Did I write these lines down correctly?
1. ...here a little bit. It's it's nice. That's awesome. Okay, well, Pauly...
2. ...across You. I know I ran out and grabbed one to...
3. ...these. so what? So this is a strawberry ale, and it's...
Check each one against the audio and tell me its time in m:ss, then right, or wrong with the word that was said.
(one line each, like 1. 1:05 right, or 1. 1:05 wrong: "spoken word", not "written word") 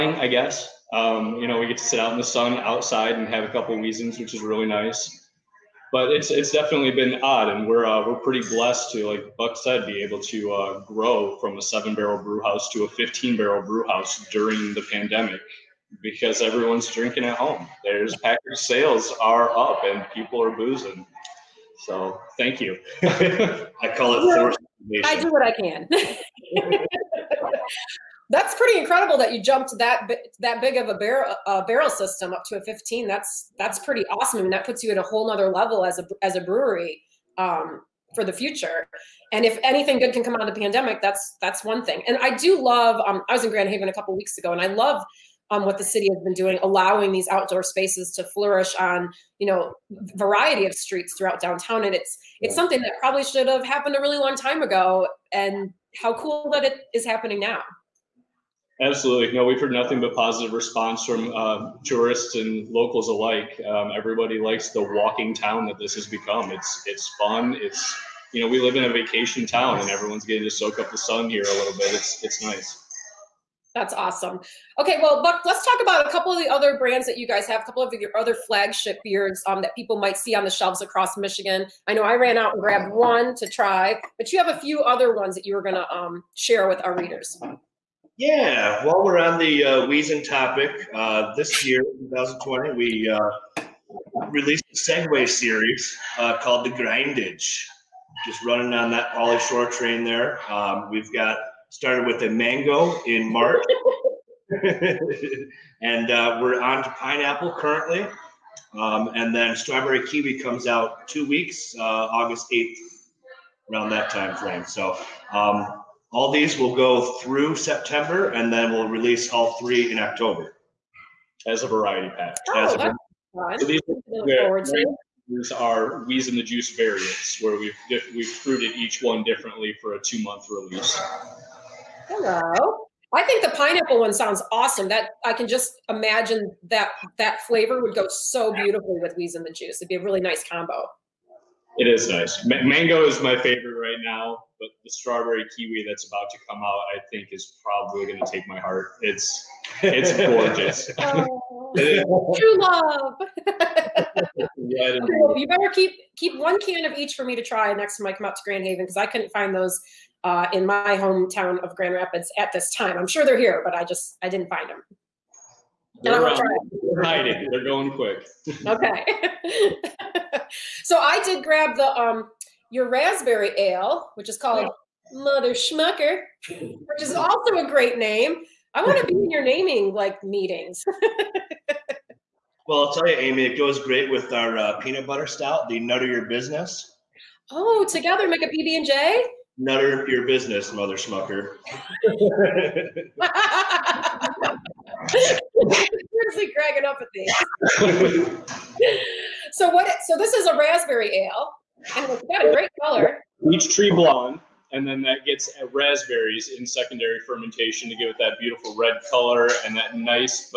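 1. 1:11 wrong: "Buck", not "Pauly"
2. 1:20 wrong: "Michigan", not "You"
3. 3:17 wrong: "raspberry", not "strawberry".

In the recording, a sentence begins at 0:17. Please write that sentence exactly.
There's package sales are up and people are boozing.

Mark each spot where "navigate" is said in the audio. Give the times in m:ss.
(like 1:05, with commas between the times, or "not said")
not said.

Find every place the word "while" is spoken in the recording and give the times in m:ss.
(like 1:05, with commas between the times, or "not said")
1:28.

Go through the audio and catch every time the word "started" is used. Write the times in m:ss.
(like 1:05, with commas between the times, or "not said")
1:41.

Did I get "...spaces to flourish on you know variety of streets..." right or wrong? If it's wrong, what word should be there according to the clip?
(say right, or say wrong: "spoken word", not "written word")
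right.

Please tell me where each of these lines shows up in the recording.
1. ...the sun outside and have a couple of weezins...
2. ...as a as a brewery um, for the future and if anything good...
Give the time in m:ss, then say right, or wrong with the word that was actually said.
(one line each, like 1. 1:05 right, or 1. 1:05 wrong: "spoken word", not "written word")
1. 0:02 right
2. 0:35 right.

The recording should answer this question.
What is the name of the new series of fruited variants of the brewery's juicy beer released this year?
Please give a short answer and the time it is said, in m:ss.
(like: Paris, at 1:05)
The Grindage, at 1:36.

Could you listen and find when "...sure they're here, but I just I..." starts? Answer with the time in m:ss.
2:43.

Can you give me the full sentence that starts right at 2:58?
I want to be in your naming like meetings.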